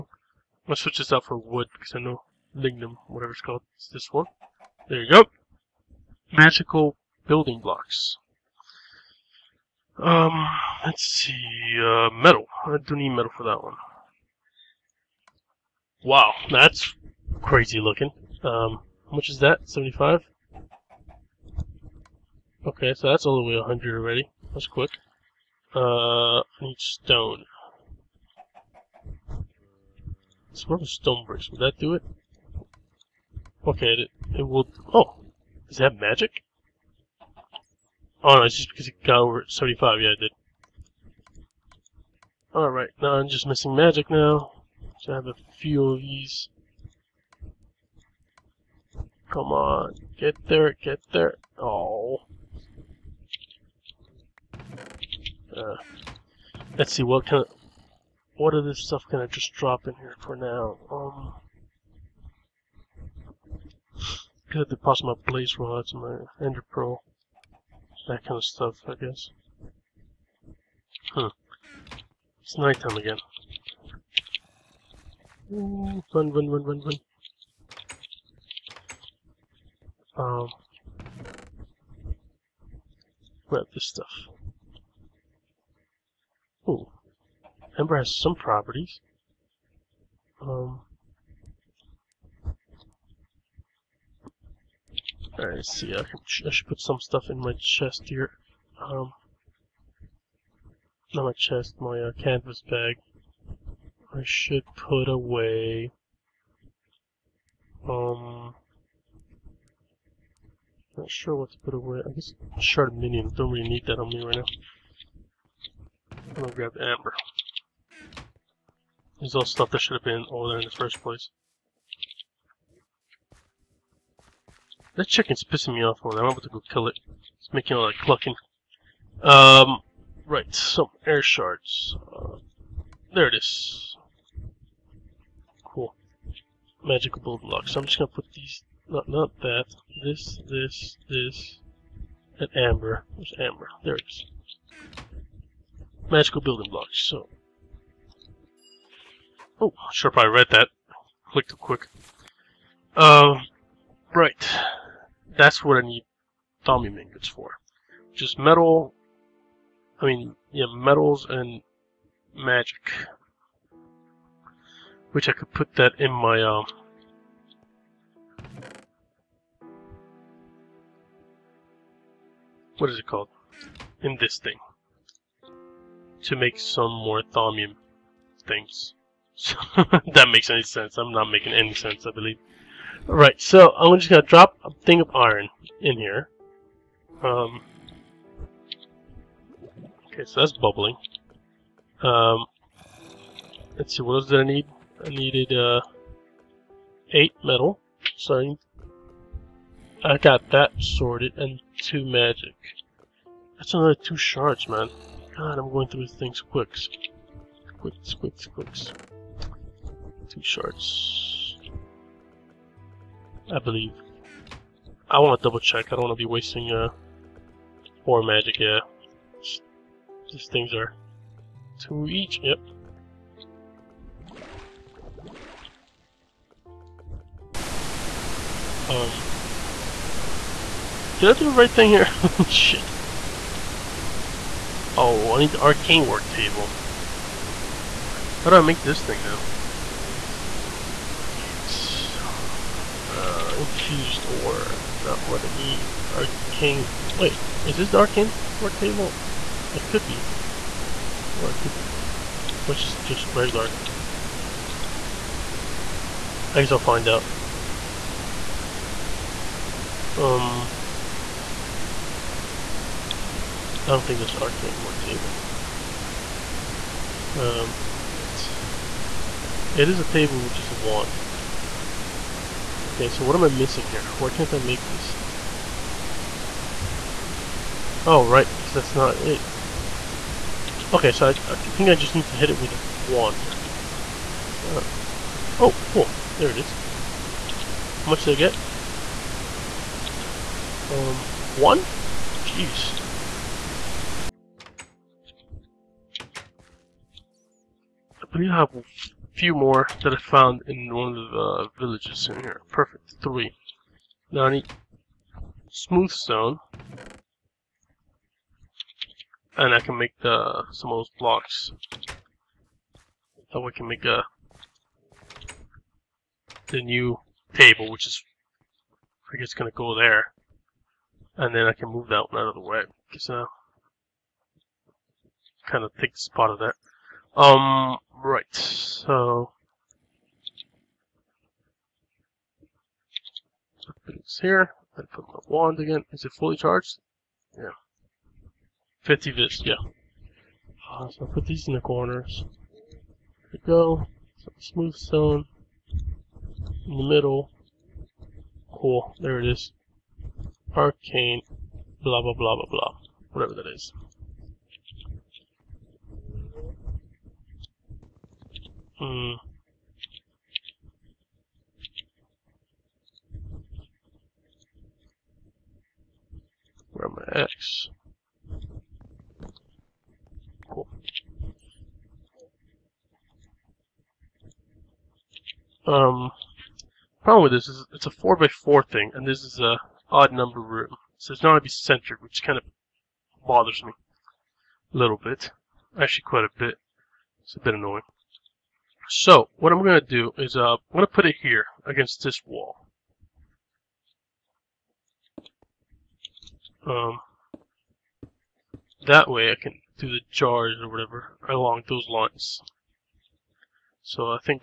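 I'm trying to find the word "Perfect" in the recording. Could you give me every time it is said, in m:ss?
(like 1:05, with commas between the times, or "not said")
5:02.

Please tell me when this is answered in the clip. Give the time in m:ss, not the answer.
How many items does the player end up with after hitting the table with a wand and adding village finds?
5:03.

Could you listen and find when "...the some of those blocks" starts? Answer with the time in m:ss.
5:10.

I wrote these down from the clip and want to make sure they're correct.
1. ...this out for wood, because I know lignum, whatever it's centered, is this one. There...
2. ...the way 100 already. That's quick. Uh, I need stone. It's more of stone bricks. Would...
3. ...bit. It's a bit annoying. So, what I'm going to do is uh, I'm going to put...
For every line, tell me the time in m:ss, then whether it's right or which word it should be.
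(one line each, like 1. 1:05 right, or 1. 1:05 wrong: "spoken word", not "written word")
1. 0:00 wrong: "called", not "centered"
2. 0:23 right
3. 6:26 right.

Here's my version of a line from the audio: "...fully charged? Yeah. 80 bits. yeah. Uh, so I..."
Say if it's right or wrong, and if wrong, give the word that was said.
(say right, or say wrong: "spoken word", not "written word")
wrong: "50", not "80".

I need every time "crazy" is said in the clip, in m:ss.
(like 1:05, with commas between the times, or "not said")
0:17.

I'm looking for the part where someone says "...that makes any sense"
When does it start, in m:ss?
3:00.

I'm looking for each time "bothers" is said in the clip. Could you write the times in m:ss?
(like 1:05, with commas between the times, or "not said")
6:23.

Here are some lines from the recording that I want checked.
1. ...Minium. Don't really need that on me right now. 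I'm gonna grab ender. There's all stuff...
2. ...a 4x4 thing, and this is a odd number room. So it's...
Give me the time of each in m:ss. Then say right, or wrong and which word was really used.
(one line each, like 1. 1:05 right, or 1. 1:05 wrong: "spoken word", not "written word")
1. 1:52 wrong: "amber", not "ender"
2. 6:18 right.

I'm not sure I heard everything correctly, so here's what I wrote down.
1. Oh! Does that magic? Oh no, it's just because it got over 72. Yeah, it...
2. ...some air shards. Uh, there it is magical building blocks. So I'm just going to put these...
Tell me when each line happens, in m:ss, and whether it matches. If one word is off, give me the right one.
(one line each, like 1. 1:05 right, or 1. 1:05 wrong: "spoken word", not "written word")
1. 0:34 wrong: "75", not "72"
2. 2:10 right.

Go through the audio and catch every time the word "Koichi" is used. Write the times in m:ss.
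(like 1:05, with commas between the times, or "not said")
not said.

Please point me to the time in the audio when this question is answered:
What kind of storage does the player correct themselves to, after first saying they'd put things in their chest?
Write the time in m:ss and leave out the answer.
1:42.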